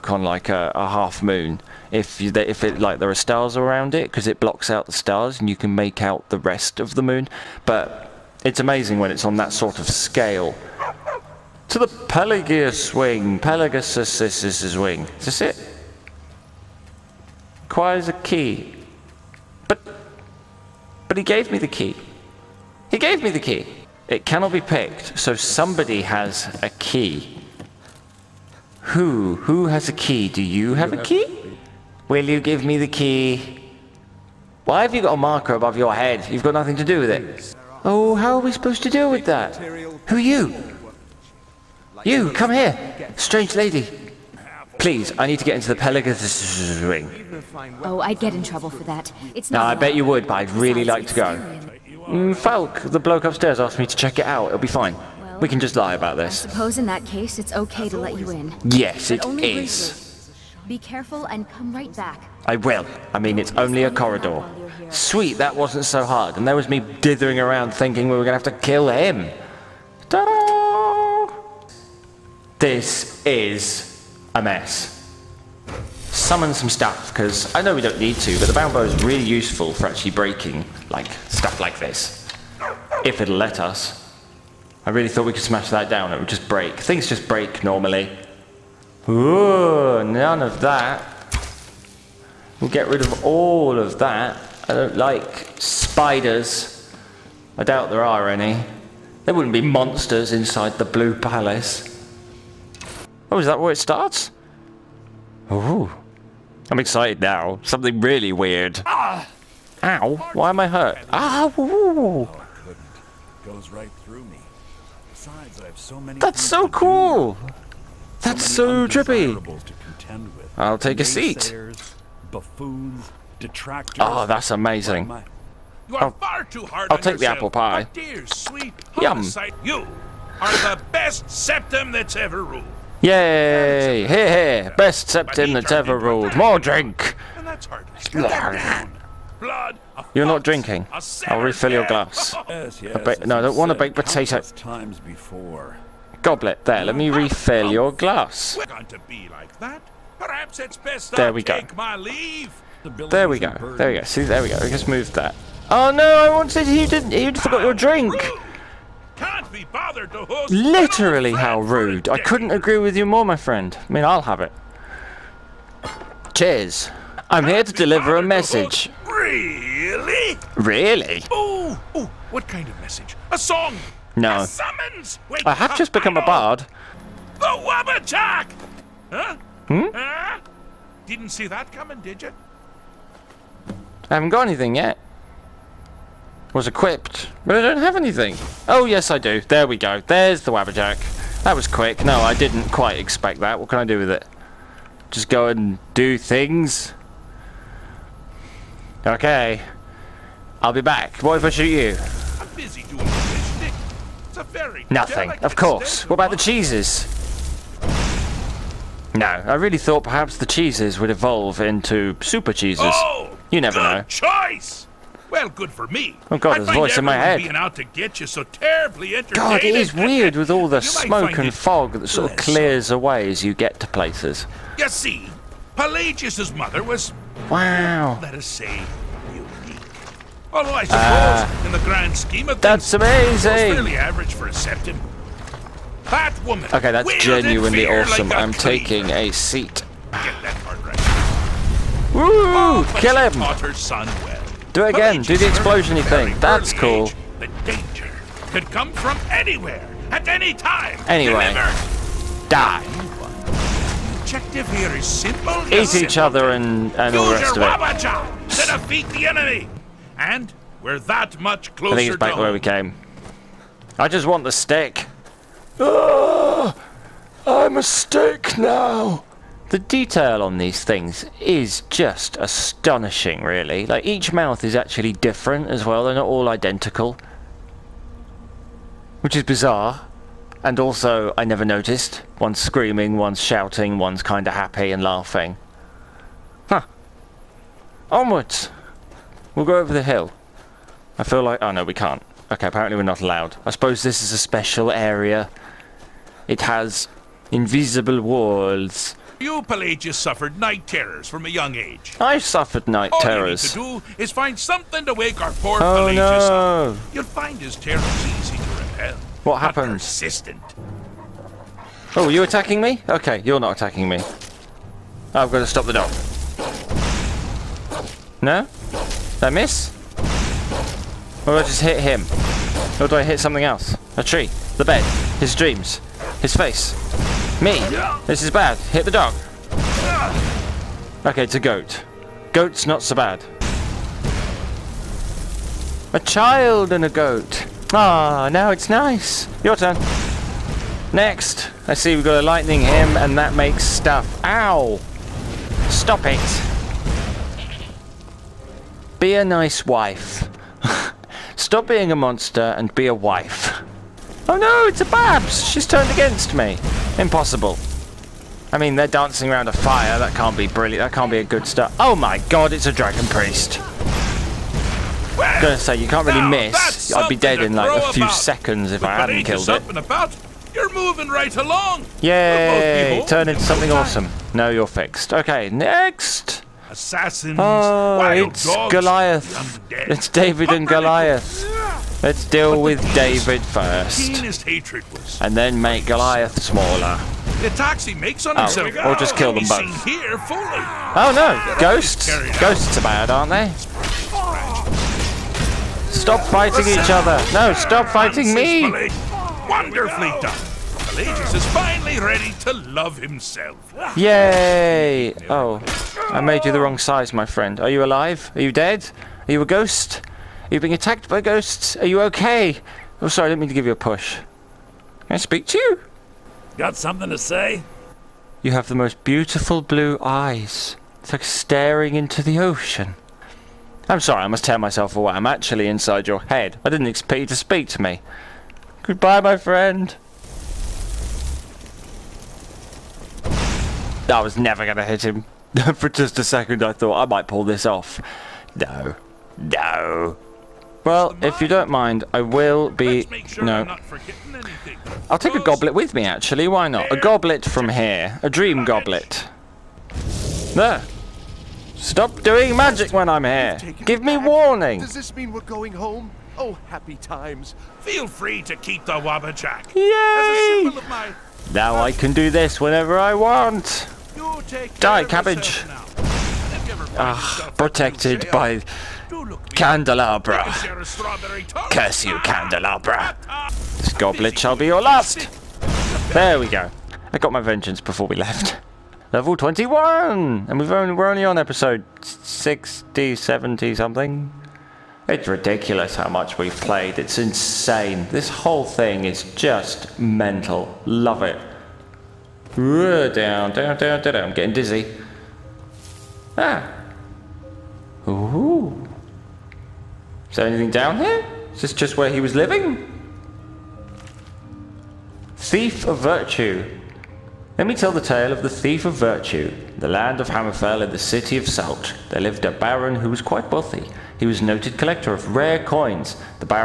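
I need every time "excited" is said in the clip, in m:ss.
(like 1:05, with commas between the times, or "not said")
1:46.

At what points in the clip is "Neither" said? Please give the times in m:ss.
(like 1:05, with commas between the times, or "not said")
not said.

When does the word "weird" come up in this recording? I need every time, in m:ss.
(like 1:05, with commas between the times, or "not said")
1:48, 3:39.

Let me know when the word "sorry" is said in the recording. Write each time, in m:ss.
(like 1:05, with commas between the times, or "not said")
6:53, 7:04.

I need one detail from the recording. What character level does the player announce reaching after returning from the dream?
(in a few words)
21.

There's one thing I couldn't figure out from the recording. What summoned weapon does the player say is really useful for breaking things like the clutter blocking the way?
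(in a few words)
bound bow.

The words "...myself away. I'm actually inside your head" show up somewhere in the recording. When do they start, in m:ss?
7:04.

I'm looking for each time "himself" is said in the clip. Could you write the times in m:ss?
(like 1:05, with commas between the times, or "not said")
6:28, 6:43.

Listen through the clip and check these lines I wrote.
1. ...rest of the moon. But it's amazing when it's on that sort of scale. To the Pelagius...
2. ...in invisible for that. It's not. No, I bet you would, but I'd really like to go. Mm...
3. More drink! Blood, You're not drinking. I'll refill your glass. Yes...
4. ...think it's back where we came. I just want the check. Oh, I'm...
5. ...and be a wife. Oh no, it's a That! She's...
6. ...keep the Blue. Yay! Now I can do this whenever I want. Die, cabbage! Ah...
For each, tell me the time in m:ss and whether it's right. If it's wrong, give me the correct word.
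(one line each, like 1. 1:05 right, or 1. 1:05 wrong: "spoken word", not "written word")
1. 0:06 right
2. 0:48 wrong: "trouble", not "invisible"
3. 2:16 right
4. 4:21 wrong: "stick", not "check"
5. 5:52 wrong: "Babs", not "That"
6. 7:38 wrong: "Wabbajack", not "Blue".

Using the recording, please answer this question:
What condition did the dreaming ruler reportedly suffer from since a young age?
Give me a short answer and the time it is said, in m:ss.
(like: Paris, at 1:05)
night terrors, at 5:00.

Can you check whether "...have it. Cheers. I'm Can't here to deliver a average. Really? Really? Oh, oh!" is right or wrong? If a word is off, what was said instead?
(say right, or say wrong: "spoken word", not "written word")
wrong: "message", not "average".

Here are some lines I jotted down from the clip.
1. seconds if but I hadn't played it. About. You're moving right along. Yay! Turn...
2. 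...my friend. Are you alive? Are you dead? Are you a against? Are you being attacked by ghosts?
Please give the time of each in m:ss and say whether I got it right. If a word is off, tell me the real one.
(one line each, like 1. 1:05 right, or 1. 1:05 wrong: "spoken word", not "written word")
1. 6:08 wrong: "killed", not "played"
2. 6:47 wrong: "ghost", not "against".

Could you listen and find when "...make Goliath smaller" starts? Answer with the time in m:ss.
6:25.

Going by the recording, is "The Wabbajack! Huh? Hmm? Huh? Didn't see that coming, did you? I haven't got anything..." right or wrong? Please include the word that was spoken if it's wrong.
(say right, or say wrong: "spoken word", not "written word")
right.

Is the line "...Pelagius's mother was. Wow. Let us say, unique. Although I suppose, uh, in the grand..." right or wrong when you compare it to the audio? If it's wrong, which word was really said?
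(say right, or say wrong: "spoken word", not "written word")
right.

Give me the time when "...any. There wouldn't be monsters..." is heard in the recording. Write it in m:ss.
1:38.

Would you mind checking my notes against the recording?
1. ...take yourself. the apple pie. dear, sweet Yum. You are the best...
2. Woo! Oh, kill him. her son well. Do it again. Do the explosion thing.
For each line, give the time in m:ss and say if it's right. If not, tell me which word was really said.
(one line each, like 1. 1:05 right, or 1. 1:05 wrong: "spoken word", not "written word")
1. 2:06 right
2. 4:02 right.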